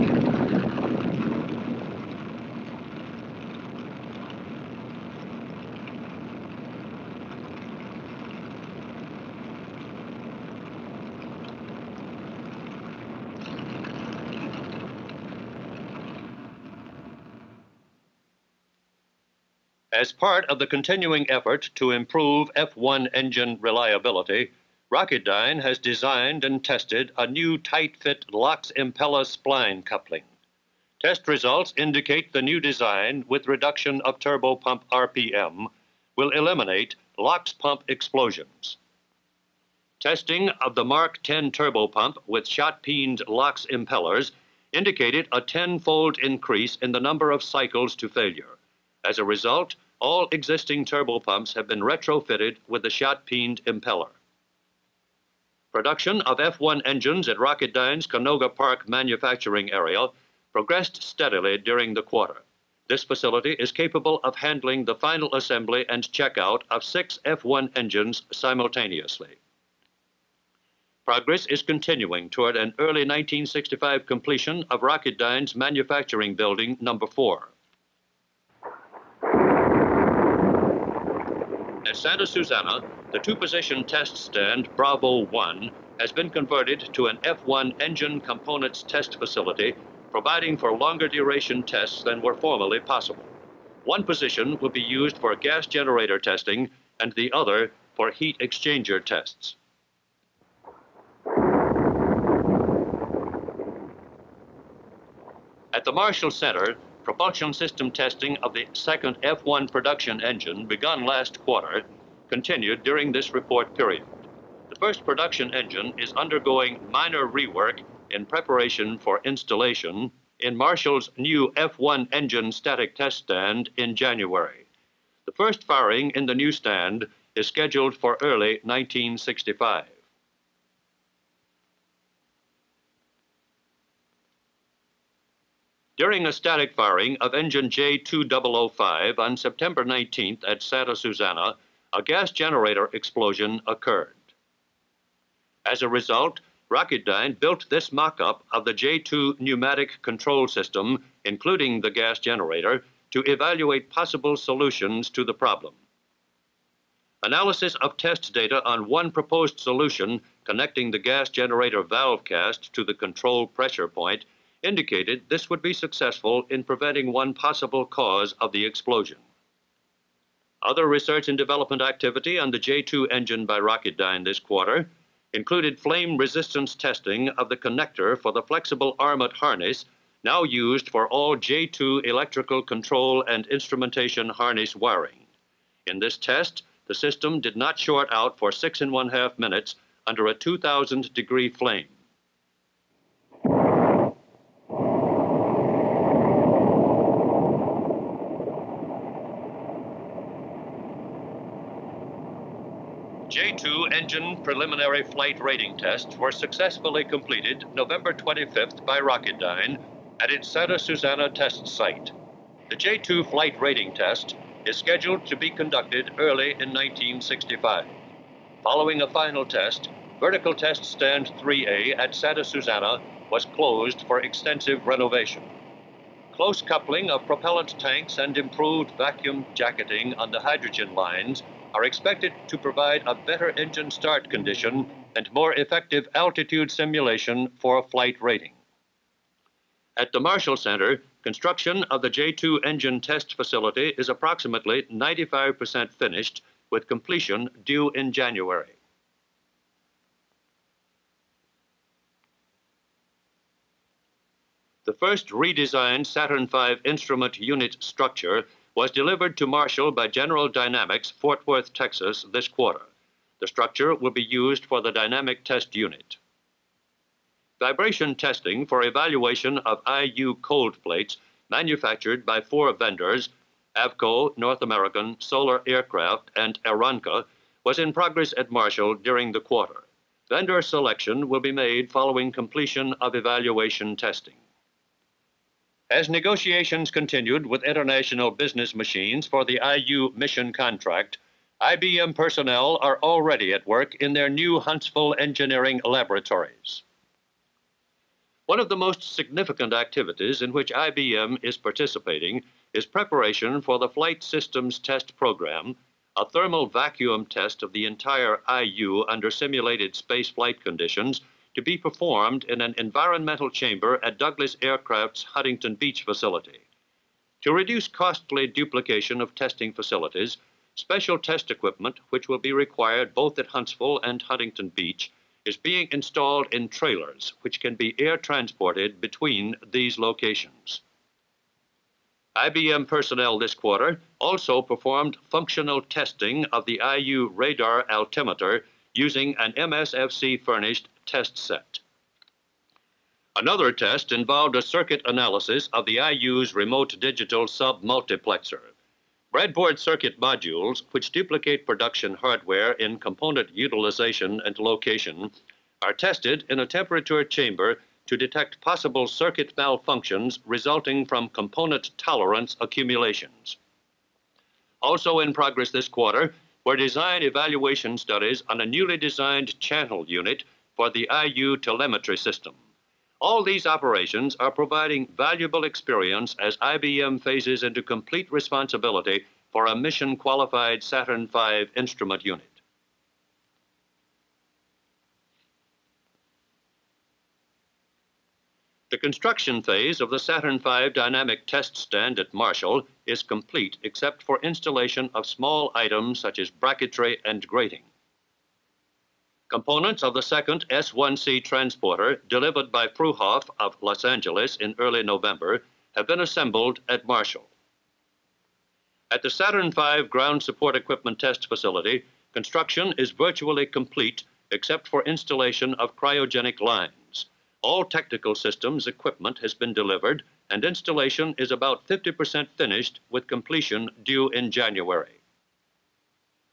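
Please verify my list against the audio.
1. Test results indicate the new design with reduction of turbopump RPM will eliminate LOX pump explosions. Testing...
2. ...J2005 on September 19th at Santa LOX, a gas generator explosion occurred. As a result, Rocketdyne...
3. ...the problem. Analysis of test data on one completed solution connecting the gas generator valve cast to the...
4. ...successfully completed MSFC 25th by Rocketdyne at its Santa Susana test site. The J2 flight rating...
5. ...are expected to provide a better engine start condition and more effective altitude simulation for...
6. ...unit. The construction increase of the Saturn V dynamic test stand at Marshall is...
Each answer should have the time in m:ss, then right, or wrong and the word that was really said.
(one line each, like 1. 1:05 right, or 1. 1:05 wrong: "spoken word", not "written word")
1. 0:30 right
2. 2:17 wrong: "Susana", not "LOX"
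3. 2:35 wrong: "proposed", not "completed"
4. 3:26 wrong: "November", not "MSFC"
5. 3:51 right
6. 6:22 wrong: "phase", not "increase".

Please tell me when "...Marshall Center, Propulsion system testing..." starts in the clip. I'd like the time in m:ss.
1:45.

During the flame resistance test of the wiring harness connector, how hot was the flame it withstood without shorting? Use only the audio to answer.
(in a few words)
2,000 degrees.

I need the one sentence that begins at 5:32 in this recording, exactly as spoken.
IBM personnel this quarter also performed functional testing of the IU radar altimeter using an MSFC furnished test set.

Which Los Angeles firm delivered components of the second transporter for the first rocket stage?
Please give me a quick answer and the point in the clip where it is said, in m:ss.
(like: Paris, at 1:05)
Pruhoff, at 6:42.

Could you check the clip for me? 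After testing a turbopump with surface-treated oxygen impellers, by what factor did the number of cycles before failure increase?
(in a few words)
tenfold.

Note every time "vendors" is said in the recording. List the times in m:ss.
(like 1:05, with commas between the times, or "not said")
4:32, 4:40.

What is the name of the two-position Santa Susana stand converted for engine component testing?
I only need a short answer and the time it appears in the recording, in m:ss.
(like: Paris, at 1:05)
Bravo 1, at 1:24.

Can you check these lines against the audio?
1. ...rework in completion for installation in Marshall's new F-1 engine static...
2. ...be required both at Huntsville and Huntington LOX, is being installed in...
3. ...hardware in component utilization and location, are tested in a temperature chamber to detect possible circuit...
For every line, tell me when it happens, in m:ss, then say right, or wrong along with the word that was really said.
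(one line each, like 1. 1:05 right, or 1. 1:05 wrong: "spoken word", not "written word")
1. 1:57 wrong: "preparation", not "completion"
2. 5:22 wrong: "Beach", not "LOX"
3. 5:52 right.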